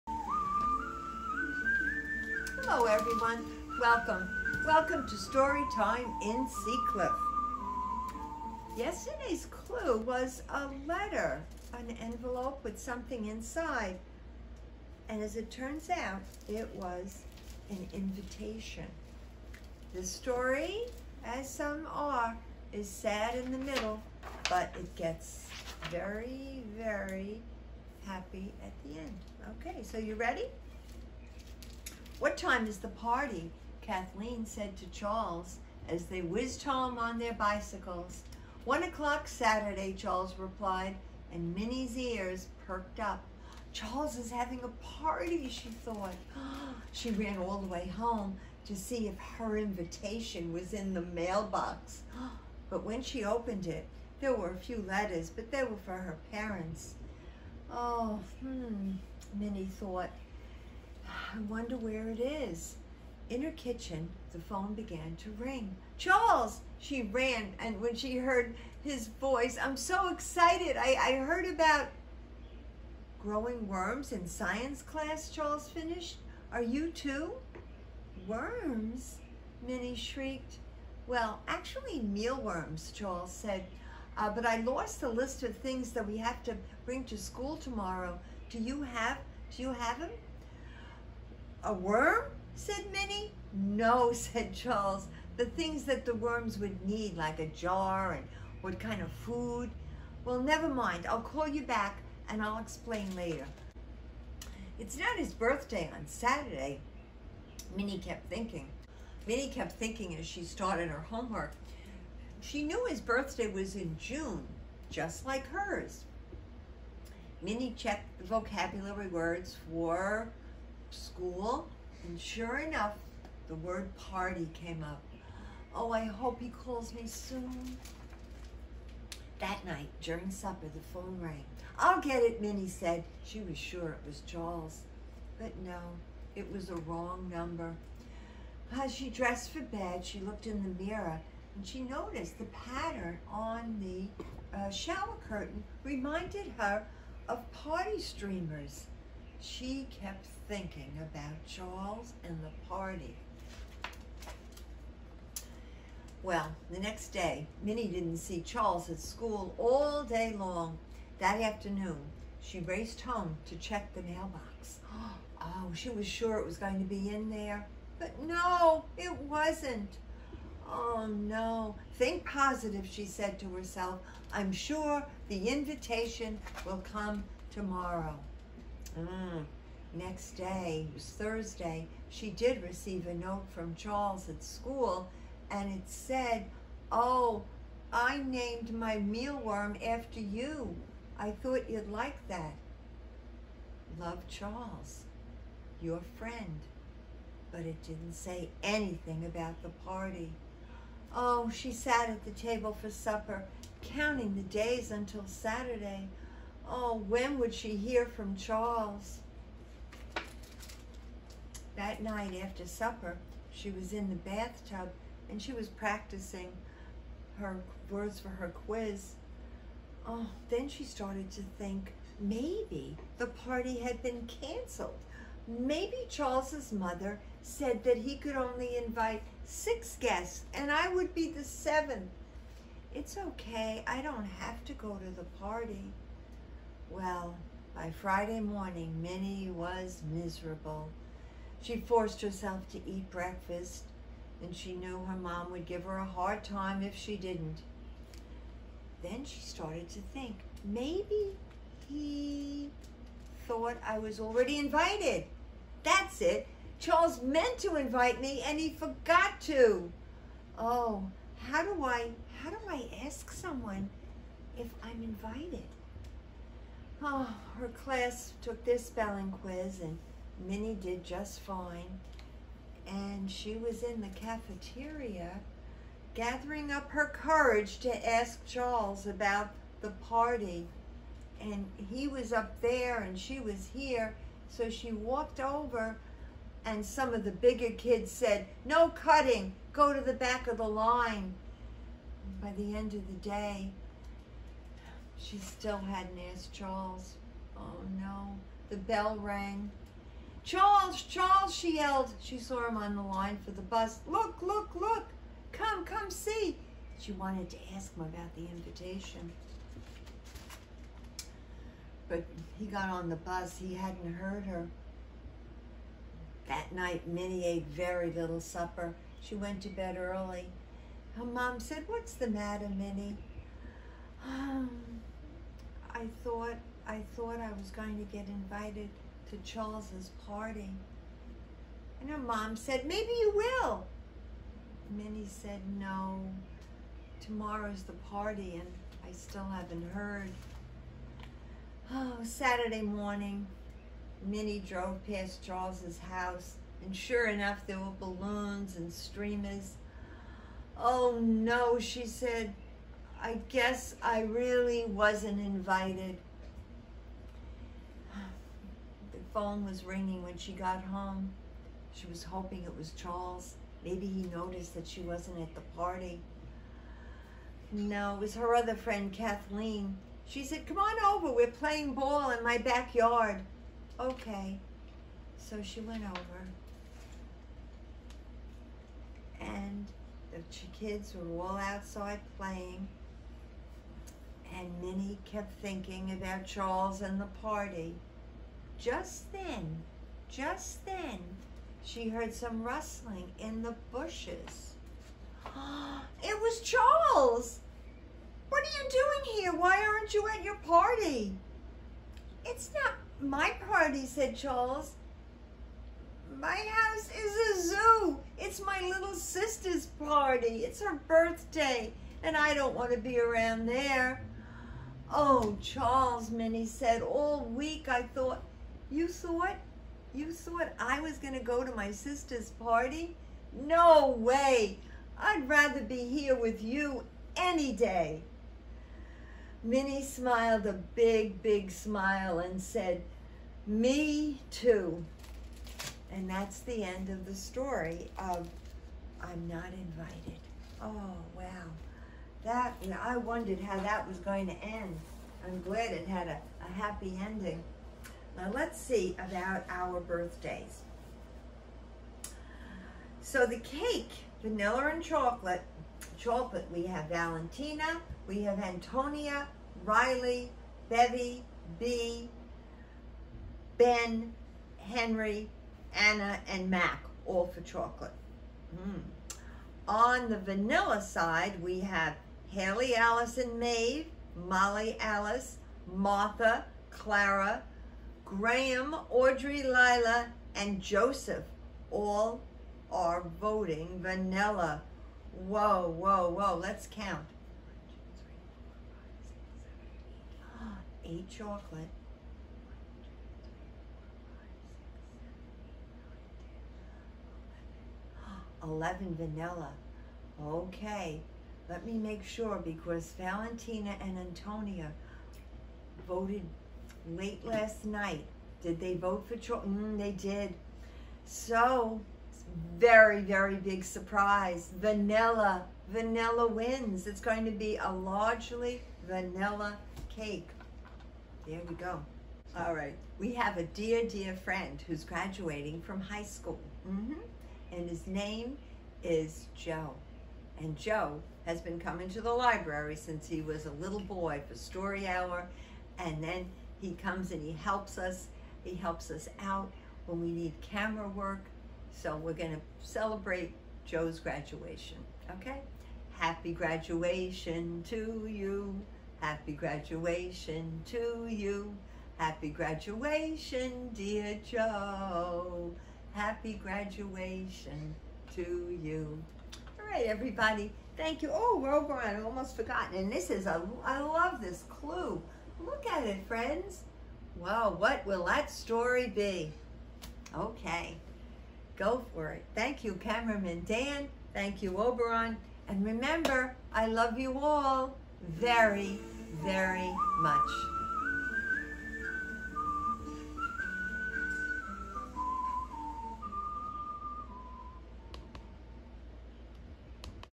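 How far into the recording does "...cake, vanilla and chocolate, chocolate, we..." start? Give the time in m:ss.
7:33.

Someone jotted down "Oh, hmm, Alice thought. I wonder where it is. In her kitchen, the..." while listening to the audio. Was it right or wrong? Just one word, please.
wrong.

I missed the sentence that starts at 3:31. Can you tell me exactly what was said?
That night after supper, she was in the bathtub and she was practicing her words for her quiz.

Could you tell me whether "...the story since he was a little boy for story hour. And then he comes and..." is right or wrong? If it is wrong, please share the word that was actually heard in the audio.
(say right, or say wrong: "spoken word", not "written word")
wrong: "library", not "story".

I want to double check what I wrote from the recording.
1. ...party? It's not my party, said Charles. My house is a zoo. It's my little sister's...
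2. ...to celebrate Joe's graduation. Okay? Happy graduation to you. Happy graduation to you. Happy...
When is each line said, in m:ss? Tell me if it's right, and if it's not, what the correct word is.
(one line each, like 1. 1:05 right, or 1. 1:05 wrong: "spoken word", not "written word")
1. 6:40 right
2. 9:02 right.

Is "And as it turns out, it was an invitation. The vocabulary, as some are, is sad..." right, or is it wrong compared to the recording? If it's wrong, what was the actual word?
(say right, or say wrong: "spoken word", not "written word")
wrong: "story", not "vocabulary".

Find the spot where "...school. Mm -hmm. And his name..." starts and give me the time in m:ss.
8:46.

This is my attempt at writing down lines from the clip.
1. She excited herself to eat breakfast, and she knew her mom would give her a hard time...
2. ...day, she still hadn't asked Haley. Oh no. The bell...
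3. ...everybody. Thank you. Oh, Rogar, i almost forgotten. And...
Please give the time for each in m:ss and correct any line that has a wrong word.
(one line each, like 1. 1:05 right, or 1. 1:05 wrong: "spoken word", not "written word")
1. 4:01 wrong: "forced", not "excited"
2. 4:53 wrong: "Charles", not "Haley"
3. 9:20 right.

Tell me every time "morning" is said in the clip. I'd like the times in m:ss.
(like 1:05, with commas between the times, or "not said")
3:58, 5:42.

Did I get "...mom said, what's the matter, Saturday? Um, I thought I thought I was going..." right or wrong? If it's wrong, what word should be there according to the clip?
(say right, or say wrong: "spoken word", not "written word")
wrong: "Minnie", not "Saturday".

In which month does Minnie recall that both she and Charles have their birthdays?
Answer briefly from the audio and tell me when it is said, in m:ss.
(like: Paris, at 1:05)
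June, at 1:53.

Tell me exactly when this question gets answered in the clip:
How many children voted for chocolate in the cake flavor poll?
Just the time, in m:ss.
8:11.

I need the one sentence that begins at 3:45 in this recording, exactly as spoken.
Maybe Charles's mother said that he could only invite six guests and I would be the seventh.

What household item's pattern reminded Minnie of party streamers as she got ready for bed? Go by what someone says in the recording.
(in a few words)
Shower curtain.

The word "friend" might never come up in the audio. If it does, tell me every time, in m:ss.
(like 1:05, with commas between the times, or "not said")
3:16, 6:08, 8:44, 9:26.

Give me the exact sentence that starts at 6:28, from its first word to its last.
Just then, just then, she heard some rustling in the bushes.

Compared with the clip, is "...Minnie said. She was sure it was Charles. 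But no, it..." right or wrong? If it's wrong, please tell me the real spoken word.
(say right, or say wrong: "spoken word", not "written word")
right.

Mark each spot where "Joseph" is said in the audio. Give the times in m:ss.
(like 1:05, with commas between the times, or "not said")
8:00.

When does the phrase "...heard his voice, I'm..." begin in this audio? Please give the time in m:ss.
1:08.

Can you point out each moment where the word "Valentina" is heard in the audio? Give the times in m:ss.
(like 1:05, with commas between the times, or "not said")
7:37, 8:23.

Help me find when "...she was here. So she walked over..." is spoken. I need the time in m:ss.
4:43.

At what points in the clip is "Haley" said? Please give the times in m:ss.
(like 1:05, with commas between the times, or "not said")
7:52.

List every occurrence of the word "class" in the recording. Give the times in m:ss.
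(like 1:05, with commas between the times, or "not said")
1:14, 4:27.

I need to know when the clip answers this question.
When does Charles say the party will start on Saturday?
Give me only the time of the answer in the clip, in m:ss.
0:38.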